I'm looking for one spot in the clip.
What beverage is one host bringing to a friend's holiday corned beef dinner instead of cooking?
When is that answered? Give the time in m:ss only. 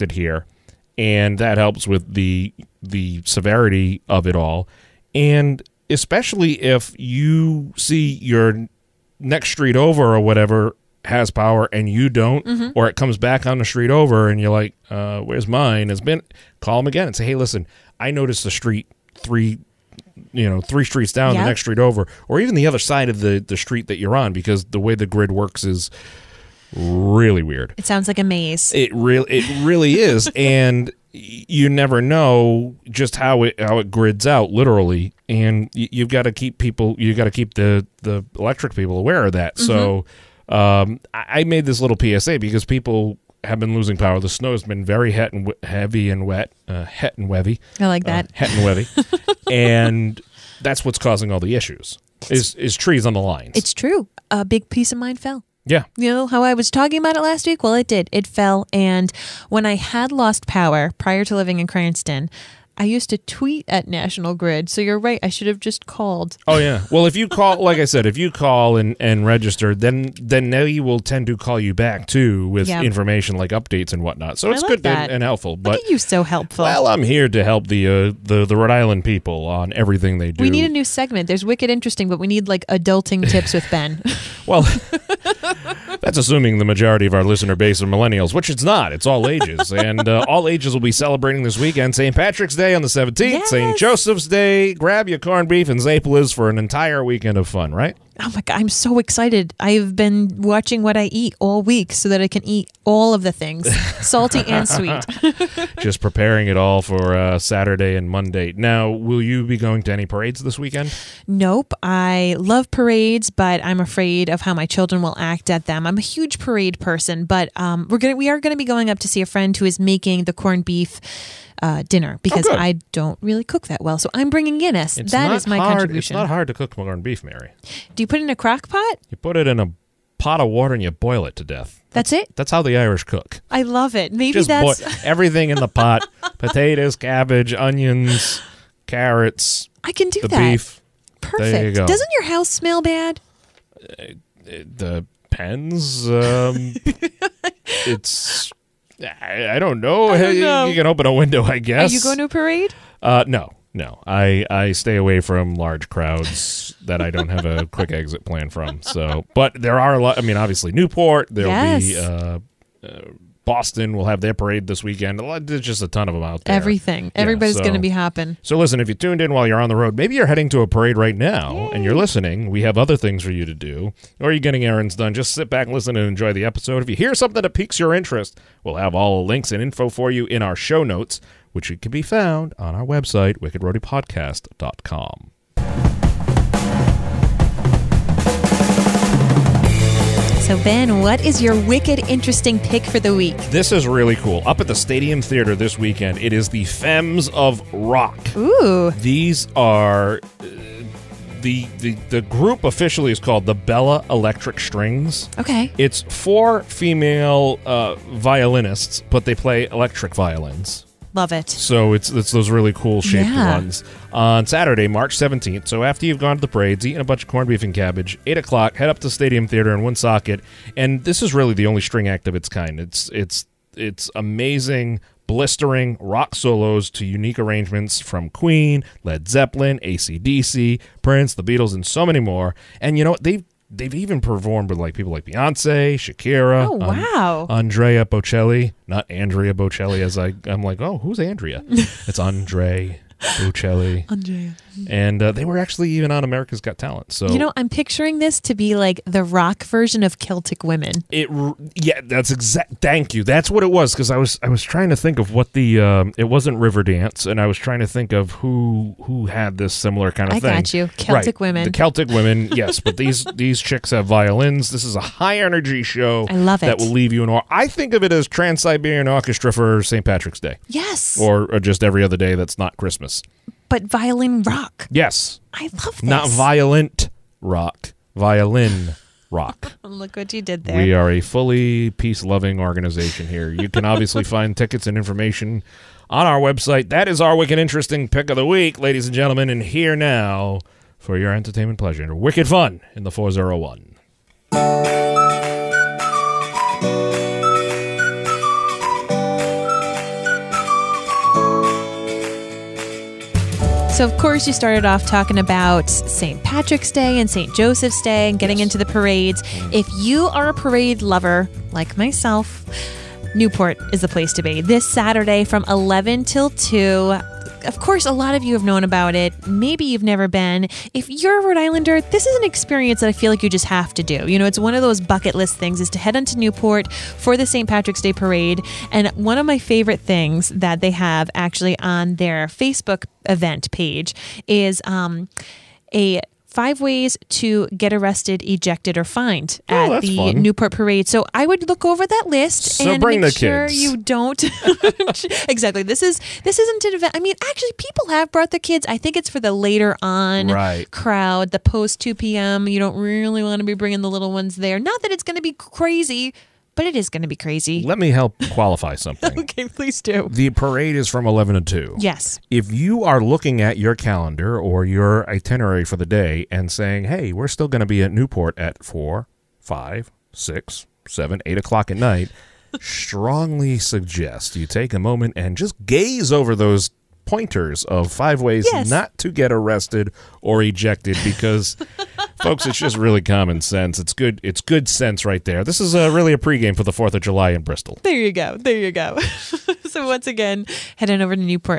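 2:04.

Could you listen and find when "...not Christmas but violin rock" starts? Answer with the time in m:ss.
4:32.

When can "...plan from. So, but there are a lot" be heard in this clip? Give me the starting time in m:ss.
2:38.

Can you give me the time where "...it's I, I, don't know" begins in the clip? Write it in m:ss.
2:27.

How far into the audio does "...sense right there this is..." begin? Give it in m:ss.
6:24.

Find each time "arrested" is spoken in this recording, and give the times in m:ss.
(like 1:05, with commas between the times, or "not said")
5:37, 6:19.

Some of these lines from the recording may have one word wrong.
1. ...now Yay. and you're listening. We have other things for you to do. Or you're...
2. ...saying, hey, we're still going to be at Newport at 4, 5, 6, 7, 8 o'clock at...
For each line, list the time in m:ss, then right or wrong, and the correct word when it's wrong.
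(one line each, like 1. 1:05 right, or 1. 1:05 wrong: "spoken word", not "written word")
1. 2:51 right
2. 6:06 right.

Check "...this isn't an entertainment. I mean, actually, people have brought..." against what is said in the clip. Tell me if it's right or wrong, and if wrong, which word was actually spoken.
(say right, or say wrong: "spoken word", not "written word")
wrong: "event", not "entertainment".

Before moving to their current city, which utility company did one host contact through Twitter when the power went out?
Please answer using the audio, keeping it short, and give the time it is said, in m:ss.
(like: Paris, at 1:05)
National Grid, at 1:03.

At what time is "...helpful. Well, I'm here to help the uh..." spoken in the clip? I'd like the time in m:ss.
1:16.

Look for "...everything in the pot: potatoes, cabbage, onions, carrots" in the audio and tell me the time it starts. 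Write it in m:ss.
2:15.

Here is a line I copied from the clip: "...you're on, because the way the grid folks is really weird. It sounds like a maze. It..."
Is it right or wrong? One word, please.
wrong.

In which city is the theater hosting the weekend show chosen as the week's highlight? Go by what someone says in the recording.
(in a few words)
Woonsocket.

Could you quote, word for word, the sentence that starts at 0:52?
Is is trees on the lines?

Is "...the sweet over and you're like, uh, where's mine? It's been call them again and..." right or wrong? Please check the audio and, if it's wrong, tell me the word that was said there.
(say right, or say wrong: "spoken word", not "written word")
wrong: "street", not "sweet".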